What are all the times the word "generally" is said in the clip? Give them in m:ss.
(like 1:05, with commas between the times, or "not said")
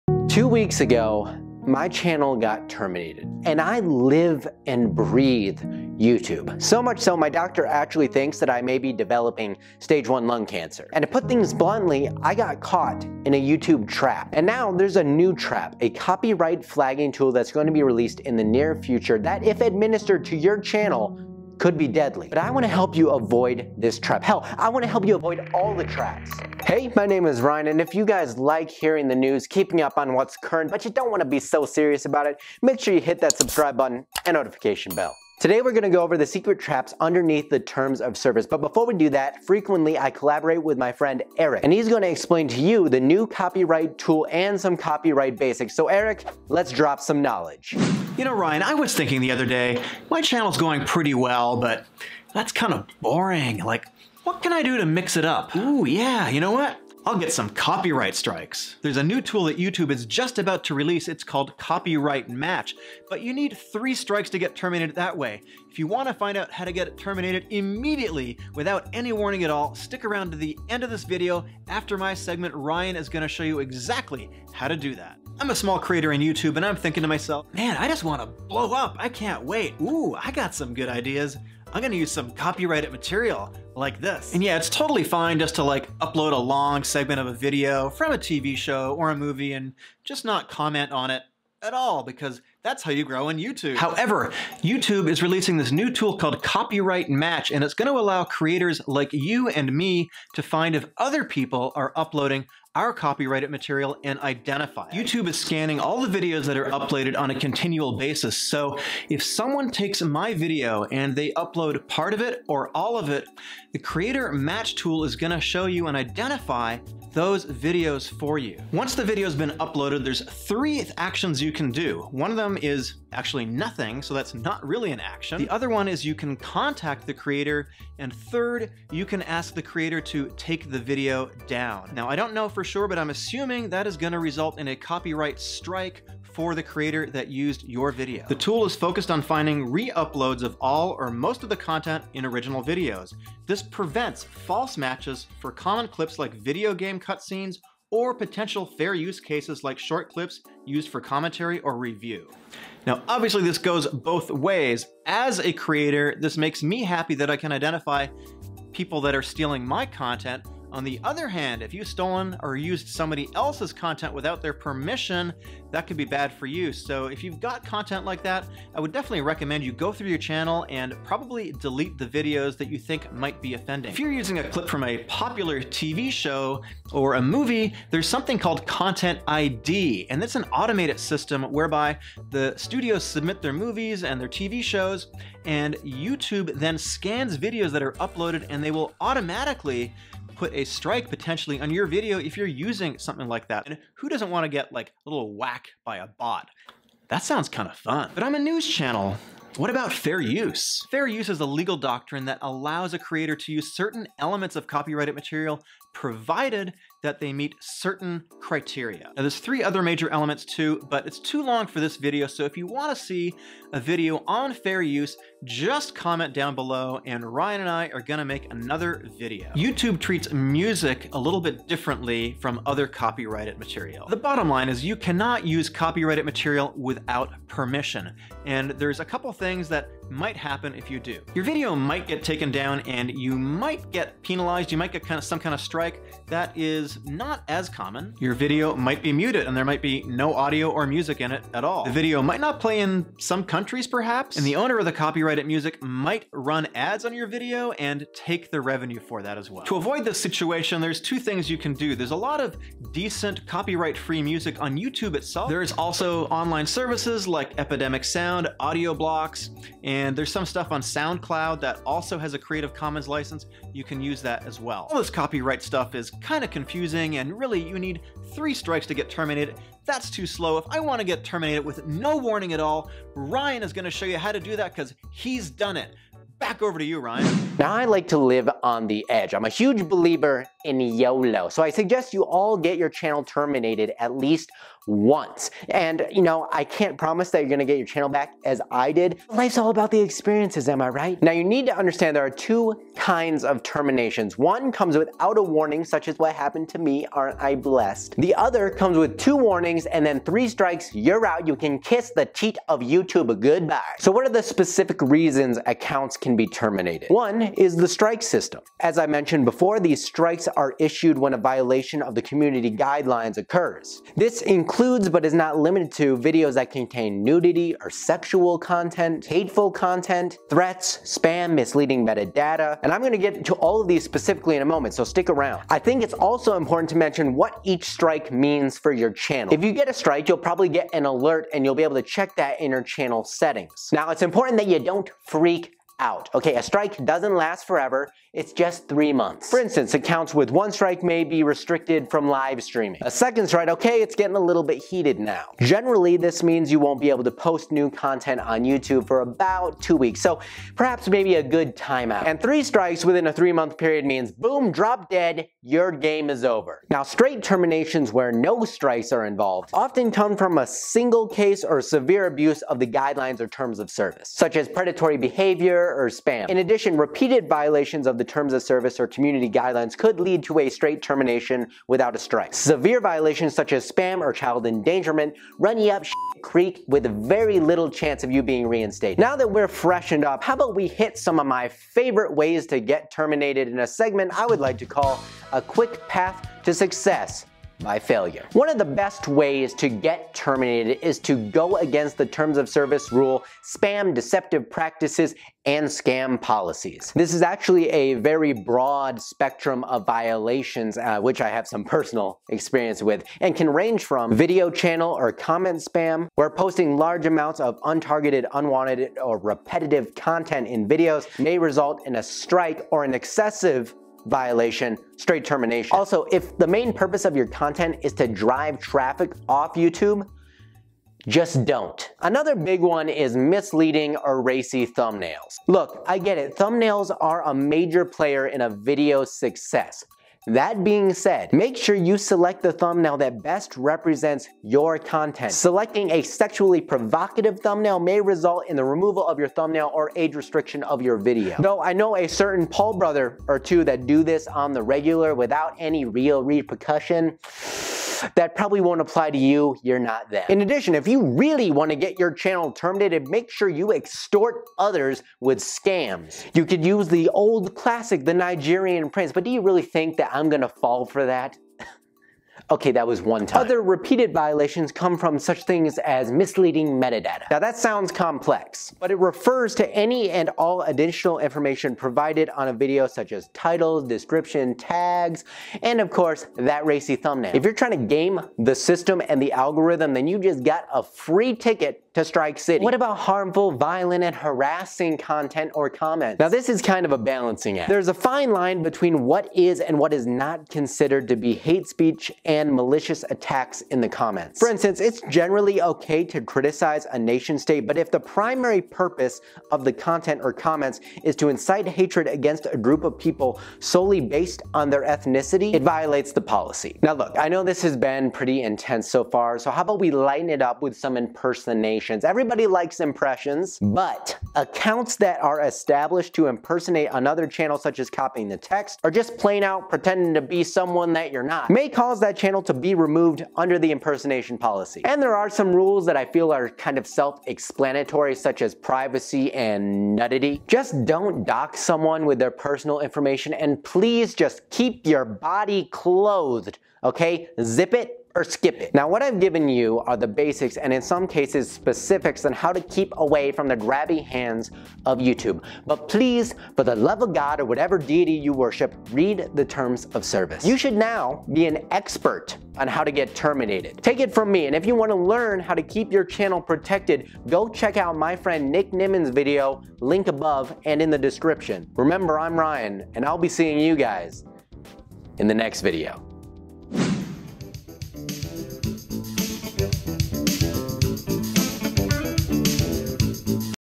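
5:45, 8:15.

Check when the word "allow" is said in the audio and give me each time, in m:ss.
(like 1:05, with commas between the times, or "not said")
1:37, 3:22.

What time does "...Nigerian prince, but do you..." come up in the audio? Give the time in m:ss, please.
7:38.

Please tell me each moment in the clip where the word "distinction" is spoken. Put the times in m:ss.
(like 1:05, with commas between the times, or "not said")
not said.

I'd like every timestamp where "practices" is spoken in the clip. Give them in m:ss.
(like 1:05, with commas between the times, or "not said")
6:34.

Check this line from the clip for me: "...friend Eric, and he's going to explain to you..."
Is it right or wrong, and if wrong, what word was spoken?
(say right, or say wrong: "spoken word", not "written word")
right.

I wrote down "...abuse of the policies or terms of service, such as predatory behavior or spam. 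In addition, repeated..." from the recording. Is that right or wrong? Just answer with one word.
wrong.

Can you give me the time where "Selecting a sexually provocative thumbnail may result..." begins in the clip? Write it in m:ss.
7:15.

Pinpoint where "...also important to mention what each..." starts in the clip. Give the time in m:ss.
5:26.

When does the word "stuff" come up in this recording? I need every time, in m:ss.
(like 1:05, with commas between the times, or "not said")
4:20, 4:25.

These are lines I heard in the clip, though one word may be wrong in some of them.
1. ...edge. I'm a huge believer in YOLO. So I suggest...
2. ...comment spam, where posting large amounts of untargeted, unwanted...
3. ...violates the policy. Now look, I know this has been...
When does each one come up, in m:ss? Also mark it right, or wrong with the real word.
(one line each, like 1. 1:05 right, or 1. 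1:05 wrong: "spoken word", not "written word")
1. 4:39 right
2. 6:45 right
3. 8:25 right.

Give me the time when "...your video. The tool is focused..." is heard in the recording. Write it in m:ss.
2:17.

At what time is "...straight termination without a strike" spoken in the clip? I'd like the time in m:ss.
6:10.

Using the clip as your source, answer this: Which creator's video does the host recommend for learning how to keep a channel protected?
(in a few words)
Nick Nimmin.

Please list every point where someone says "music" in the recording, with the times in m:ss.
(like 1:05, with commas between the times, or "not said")
3:40, 4:00, 4:05, 4:14.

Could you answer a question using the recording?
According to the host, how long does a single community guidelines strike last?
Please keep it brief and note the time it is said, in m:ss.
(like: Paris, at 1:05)
3 months, at 5:38.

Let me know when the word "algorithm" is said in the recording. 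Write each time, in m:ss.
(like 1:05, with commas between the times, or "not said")
7:59.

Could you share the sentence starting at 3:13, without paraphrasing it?
And who doesn't want to get like a little whack by a bot?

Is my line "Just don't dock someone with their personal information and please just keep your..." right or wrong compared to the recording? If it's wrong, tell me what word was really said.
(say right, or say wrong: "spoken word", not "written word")
right.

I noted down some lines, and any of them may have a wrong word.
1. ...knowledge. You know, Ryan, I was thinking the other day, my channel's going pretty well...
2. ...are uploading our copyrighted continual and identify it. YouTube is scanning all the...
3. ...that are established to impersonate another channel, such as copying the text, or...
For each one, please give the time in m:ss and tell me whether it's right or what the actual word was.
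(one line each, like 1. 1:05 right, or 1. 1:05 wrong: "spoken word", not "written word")
1. 0:47 right
2. 1:41 wrong: "material", not "continual"
3. 8:35 right.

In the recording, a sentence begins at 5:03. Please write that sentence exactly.
So what are the specific reasons accounts can be terminated?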